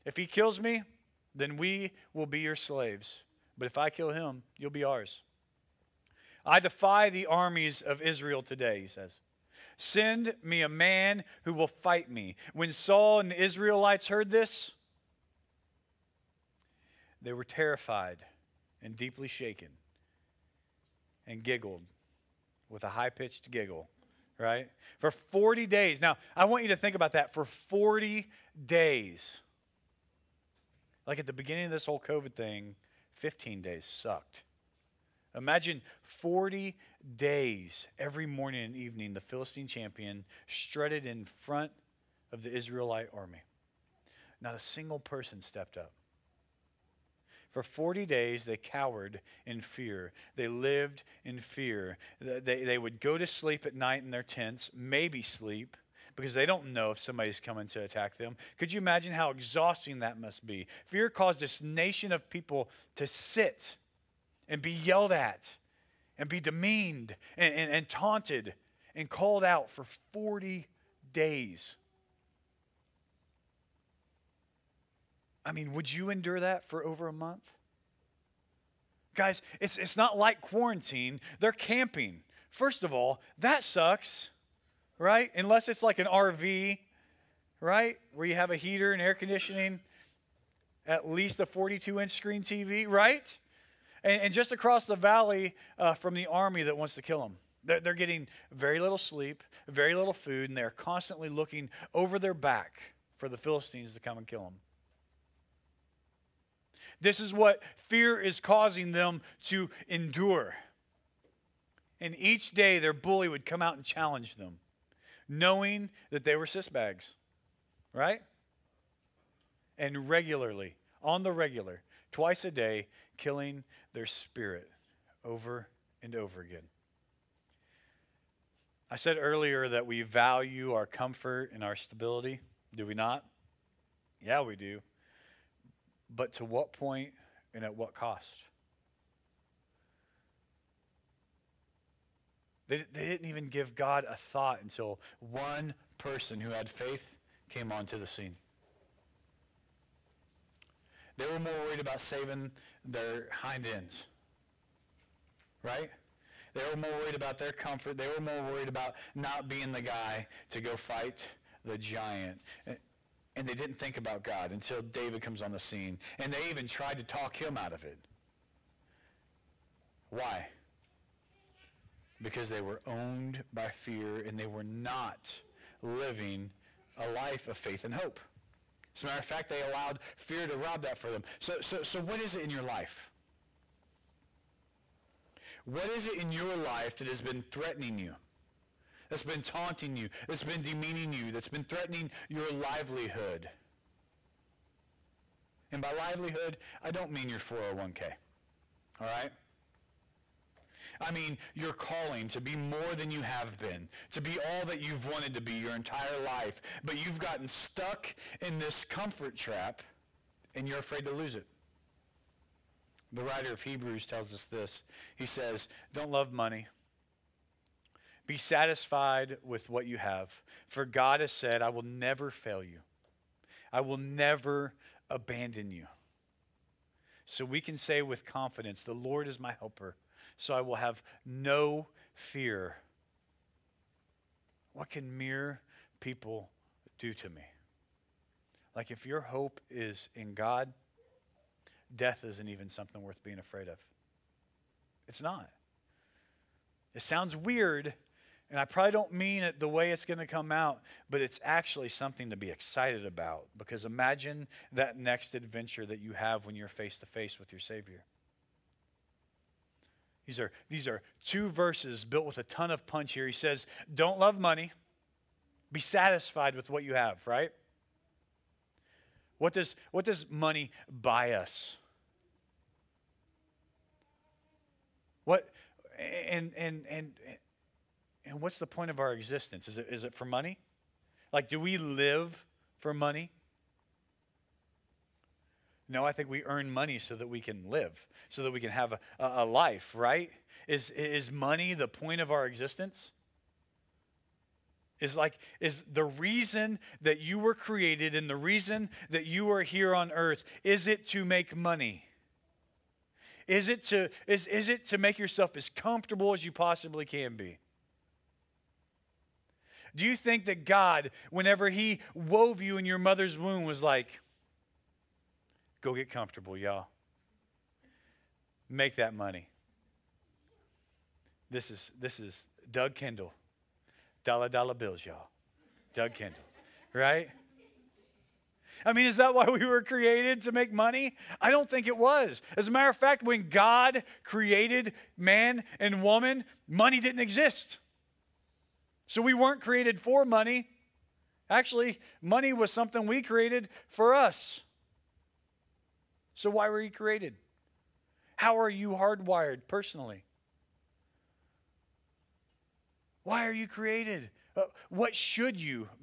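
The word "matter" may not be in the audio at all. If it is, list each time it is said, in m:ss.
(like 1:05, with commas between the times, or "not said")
2:59, 5:32.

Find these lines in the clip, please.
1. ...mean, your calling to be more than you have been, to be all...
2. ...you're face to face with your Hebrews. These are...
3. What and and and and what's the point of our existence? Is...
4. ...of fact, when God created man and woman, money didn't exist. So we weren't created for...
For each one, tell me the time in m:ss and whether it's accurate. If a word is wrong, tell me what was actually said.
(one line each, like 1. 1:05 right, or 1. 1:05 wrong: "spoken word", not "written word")
1. 3:21 right
2. 4:16 wrong: "Savior", not "Hebrews"
3. 4:35 right
4. 5:32 right.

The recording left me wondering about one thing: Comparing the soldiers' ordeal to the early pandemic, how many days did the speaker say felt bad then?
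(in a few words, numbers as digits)
15 days.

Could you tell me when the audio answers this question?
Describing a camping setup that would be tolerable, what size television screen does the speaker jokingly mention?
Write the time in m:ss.
1:31.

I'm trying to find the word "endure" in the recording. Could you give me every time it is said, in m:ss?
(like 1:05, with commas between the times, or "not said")
1:16, 1:49.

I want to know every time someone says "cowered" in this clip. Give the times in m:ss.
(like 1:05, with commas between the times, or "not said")
0:48.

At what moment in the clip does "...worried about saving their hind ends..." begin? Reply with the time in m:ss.
2:31.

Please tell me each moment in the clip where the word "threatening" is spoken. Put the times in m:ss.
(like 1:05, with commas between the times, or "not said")
3:07, 3:11.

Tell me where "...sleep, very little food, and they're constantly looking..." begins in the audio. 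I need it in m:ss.
1:38.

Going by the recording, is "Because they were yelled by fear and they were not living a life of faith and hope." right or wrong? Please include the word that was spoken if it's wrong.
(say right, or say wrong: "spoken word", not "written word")
wrong: "owned", not "yelled".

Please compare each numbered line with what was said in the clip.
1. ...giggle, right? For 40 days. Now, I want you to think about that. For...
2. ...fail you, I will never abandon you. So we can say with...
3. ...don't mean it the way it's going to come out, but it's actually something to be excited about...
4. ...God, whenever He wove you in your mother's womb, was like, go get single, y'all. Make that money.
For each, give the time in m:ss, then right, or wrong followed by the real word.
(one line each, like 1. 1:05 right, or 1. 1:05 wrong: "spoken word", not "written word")
1. 0:23 right
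2. 3:42 right
3. 4:08 right
4. 5:10 wrong: "comfortable", not "single".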